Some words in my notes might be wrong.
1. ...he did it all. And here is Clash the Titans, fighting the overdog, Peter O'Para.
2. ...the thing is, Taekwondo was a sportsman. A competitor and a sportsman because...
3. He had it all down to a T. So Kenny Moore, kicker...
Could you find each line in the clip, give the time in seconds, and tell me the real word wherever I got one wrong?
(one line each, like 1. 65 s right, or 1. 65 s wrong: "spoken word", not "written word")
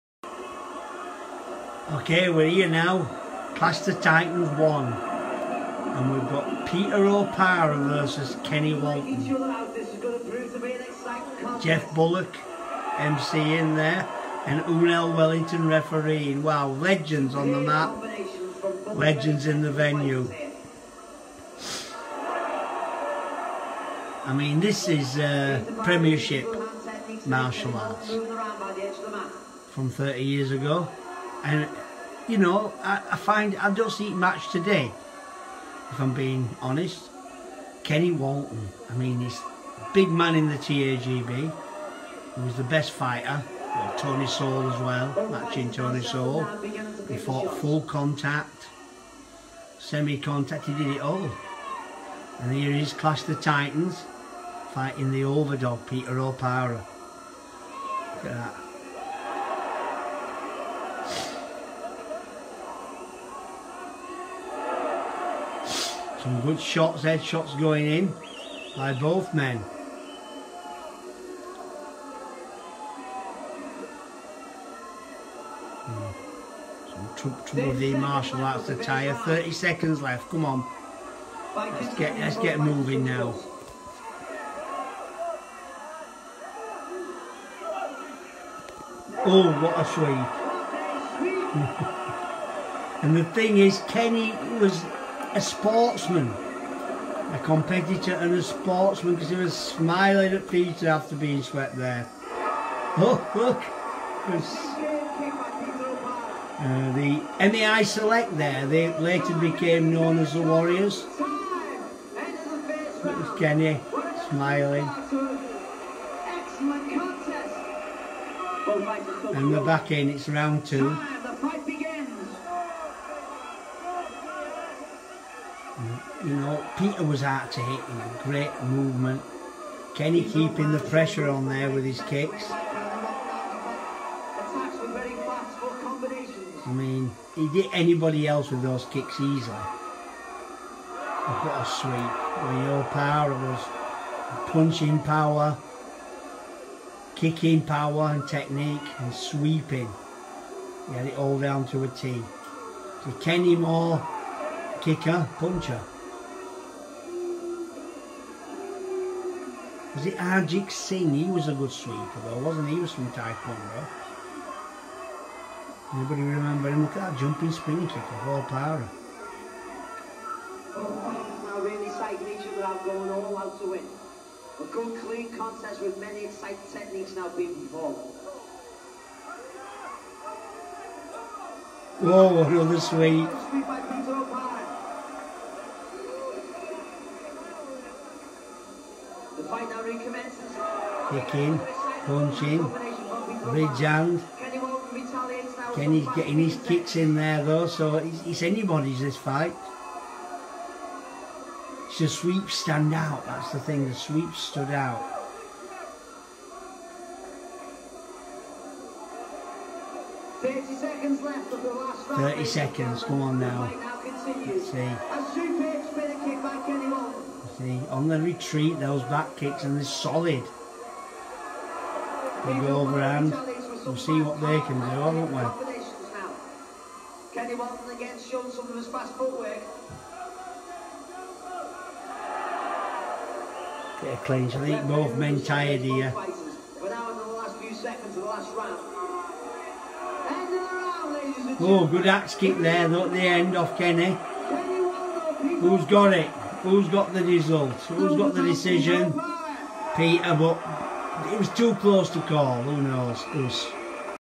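1. 50 s right
2. 93 s wrong: "Kenny", not "Taekwondo"
3. 150 s right.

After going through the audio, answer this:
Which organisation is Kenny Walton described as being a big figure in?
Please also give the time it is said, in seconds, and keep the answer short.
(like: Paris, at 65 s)
TAGB, at 40 s.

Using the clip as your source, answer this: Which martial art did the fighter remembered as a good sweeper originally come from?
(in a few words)
Taekwondo.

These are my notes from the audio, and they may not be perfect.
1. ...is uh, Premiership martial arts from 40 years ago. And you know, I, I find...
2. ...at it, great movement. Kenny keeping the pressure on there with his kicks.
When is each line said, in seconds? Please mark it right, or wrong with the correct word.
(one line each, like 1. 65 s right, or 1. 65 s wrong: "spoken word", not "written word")
1. 24 s wrong: "30", not "40"
2. 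127 s right.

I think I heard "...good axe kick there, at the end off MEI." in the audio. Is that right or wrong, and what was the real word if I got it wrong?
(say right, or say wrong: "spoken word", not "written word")
wrong: "Kenny", not "MEI".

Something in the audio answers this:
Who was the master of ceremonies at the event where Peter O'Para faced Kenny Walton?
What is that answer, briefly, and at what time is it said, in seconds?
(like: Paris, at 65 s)
Jeff Bullock, at 11 s.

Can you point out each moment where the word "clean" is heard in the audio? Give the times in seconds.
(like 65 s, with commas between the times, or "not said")
175 s, 234 s.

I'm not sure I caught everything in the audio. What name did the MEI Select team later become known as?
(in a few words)
the Warriors.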